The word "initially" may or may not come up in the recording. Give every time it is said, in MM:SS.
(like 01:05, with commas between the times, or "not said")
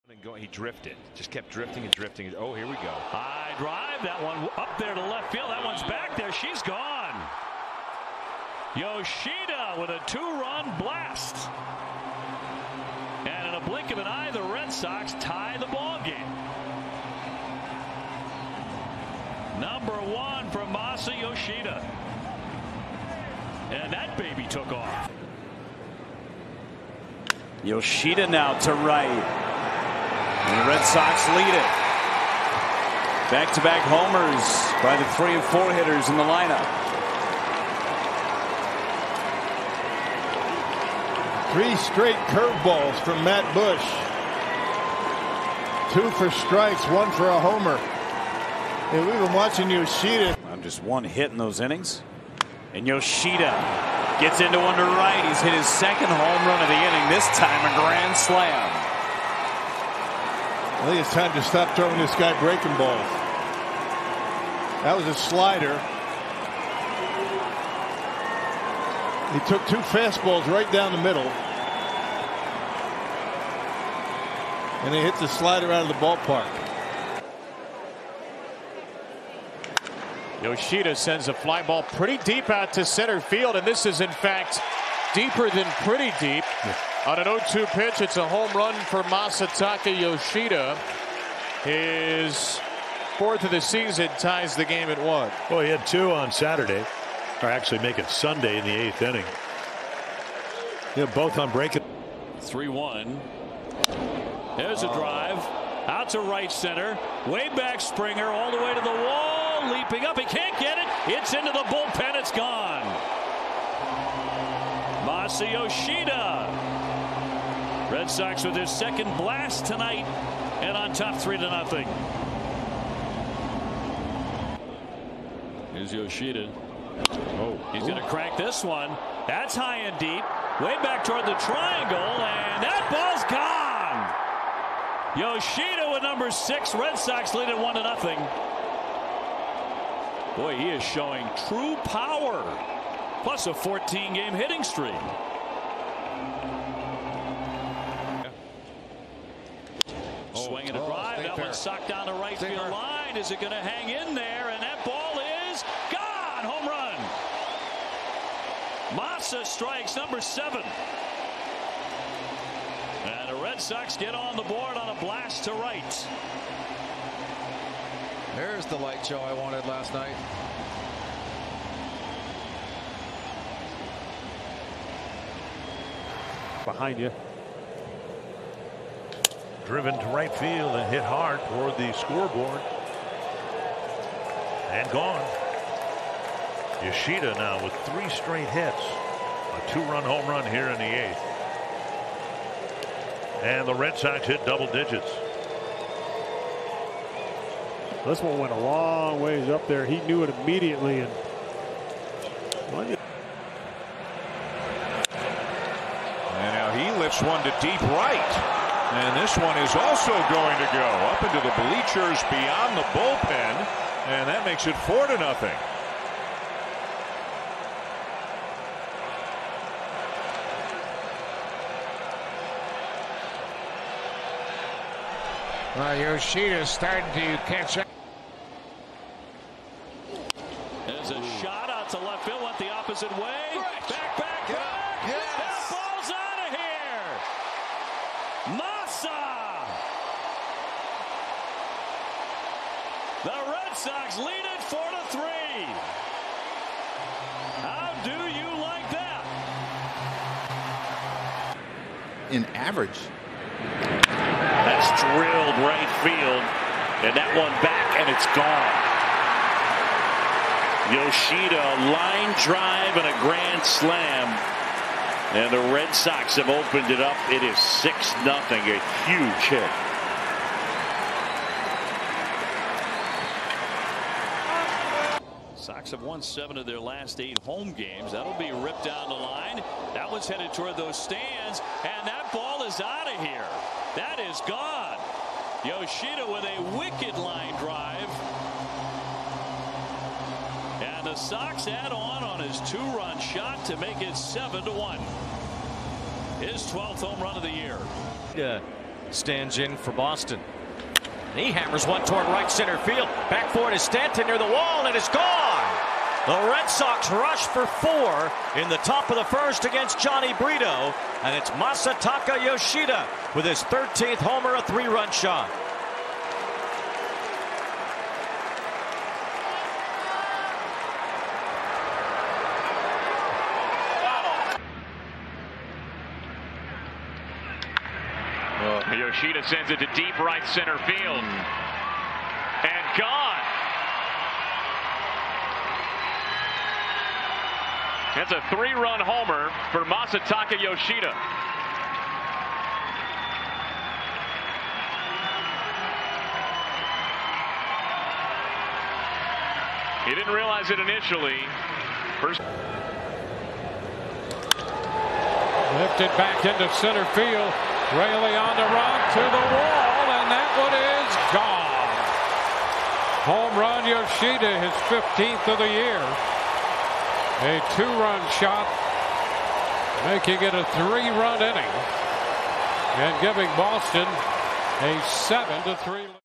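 05:50.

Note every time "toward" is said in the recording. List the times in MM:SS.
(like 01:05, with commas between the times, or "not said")
02:11, 03:01, 04:40, 05:02.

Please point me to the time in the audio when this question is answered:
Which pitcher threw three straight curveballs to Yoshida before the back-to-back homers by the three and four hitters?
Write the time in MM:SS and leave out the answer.
00:43.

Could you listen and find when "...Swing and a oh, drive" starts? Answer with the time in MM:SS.
02:30.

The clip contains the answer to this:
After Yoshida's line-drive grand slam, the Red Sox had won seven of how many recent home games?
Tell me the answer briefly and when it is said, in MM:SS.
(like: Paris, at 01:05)
8, at 04:37.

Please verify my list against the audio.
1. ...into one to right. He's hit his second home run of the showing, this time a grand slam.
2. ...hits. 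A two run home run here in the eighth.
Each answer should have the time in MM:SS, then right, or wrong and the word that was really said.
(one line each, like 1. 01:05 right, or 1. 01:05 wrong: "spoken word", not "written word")
1. 00:54 wrong: "inning", not "showing"
2. 03:08 right.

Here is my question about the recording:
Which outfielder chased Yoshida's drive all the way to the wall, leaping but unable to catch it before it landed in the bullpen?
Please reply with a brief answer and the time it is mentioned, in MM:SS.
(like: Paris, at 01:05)
Springer, at 01:47.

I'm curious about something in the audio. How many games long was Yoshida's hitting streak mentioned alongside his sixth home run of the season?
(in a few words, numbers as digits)
14.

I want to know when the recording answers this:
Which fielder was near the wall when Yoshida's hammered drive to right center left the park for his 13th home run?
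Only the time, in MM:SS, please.
05:03.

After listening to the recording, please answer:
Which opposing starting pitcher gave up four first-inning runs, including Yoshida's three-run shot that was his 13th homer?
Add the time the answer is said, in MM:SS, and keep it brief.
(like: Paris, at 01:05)
Jhony Brito, at 05:09.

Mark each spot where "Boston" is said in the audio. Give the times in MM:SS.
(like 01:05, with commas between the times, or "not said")
04:59, 06:13.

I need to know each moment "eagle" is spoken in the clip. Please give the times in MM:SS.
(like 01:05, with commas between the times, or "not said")
not said.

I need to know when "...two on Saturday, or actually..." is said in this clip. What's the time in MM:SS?
01:35.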